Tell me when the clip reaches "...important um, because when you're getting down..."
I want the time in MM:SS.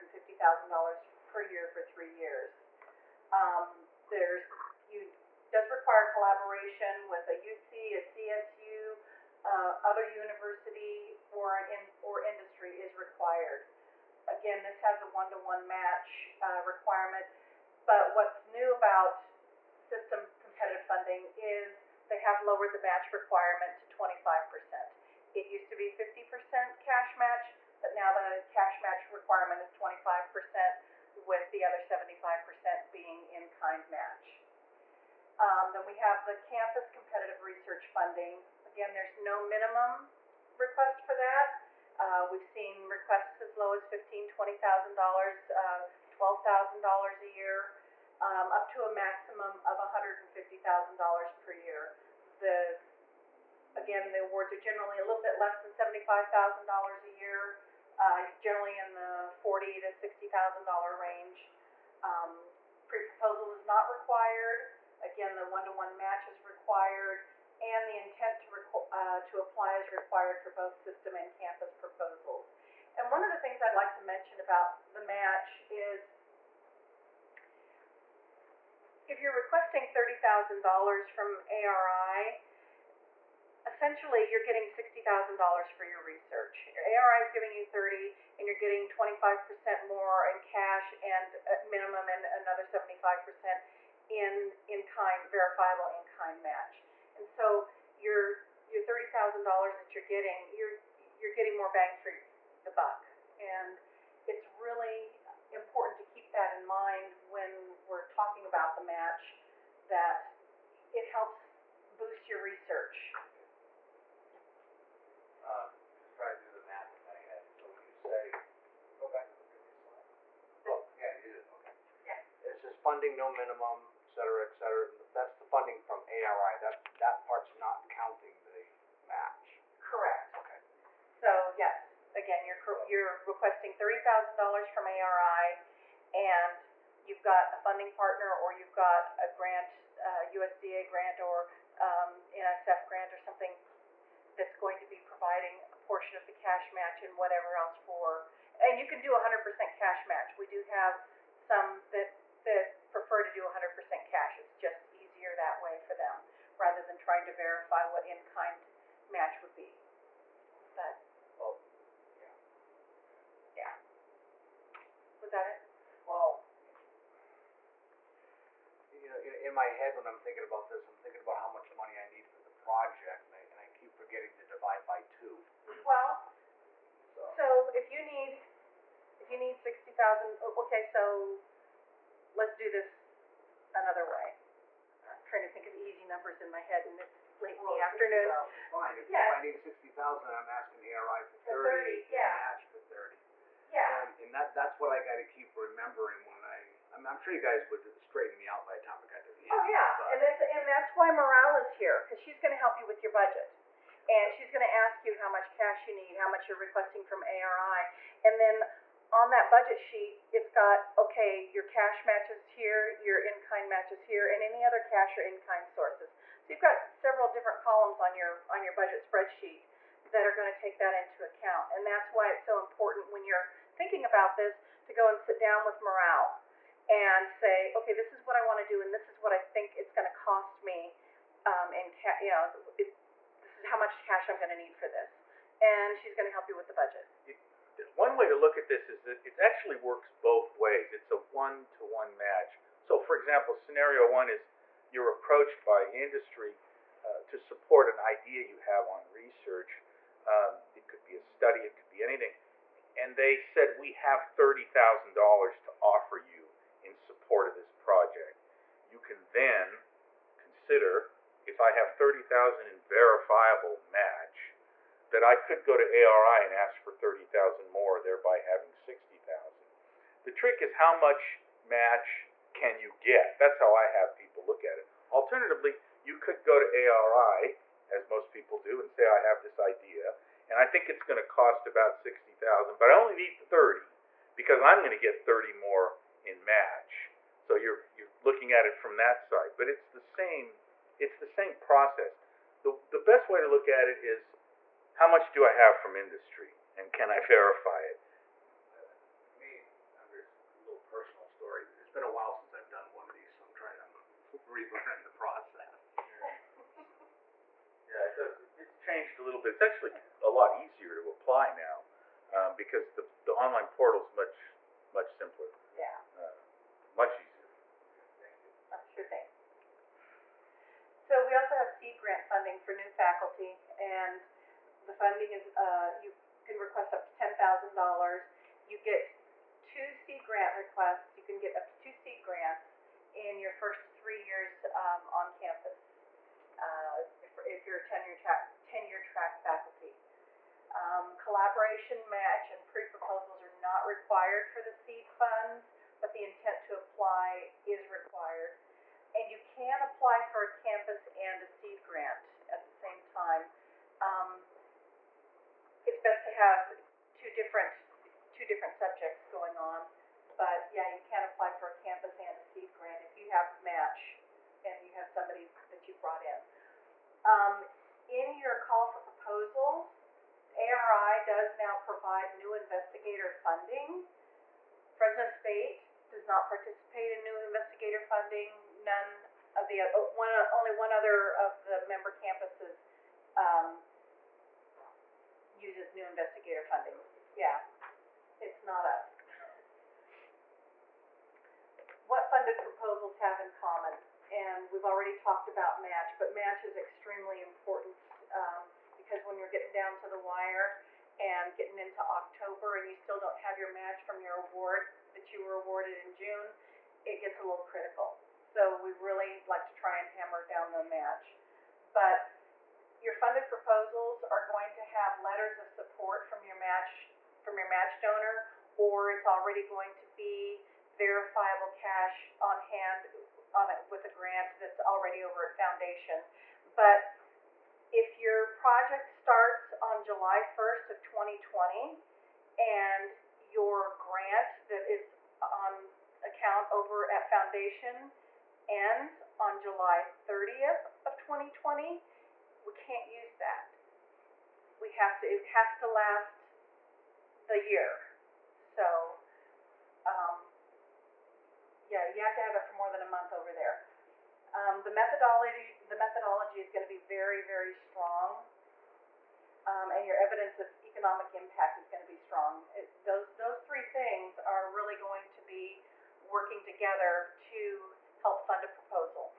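06:37.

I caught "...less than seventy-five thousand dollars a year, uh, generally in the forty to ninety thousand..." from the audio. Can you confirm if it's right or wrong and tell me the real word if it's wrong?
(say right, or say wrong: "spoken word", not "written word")
wrong: "sixty", not "ninety".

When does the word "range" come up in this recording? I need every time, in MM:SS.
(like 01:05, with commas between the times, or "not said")
01:00.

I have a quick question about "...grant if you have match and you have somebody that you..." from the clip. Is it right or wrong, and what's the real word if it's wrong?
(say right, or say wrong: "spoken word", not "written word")
right.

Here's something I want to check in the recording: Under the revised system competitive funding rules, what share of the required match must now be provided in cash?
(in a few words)
25%.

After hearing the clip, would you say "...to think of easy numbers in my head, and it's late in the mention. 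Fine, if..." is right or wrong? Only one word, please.
wrong.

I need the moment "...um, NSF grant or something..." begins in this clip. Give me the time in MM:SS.
02:21.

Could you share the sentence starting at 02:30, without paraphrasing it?
We do have some that that prefer to do 100% cash.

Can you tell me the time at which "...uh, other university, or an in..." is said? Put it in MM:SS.
00:09.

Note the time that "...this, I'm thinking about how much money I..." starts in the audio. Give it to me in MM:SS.
02:50.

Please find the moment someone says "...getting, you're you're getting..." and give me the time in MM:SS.
01:40.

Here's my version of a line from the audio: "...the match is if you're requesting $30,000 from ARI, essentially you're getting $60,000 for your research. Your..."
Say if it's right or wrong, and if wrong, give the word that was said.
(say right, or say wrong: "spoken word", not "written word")
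right.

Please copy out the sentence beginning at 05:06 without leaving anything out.
Yeah, it does, it's changed a little bit.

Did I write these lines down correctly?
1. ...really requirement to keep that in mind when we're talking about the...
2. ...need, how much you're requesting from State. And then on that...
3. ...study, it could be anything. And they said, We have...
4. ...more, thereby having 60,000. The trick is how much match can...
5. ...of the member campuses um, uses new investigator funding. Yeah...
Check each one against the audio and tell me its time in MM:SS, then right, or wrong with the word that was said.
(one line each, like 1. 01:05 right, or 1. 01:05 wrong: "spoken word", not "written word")
1. 01:44 wrong: "important", not "requirement"
2. 03:25 wrong: "ARI", not "State"
3. 04:11 right
4. 04:27 right
5. 06:21 right.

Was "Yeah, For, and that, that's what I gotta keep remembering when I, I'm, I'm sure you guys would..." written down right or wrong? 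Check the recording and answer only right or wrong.
wrong.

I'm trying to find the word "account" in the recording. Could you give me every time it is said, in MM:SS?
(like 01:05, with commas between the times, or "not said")
03:41, 07:16.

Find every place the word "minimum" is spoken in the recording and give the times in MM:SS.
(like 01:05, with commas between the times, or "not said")
00:39, 01:31, 02:03.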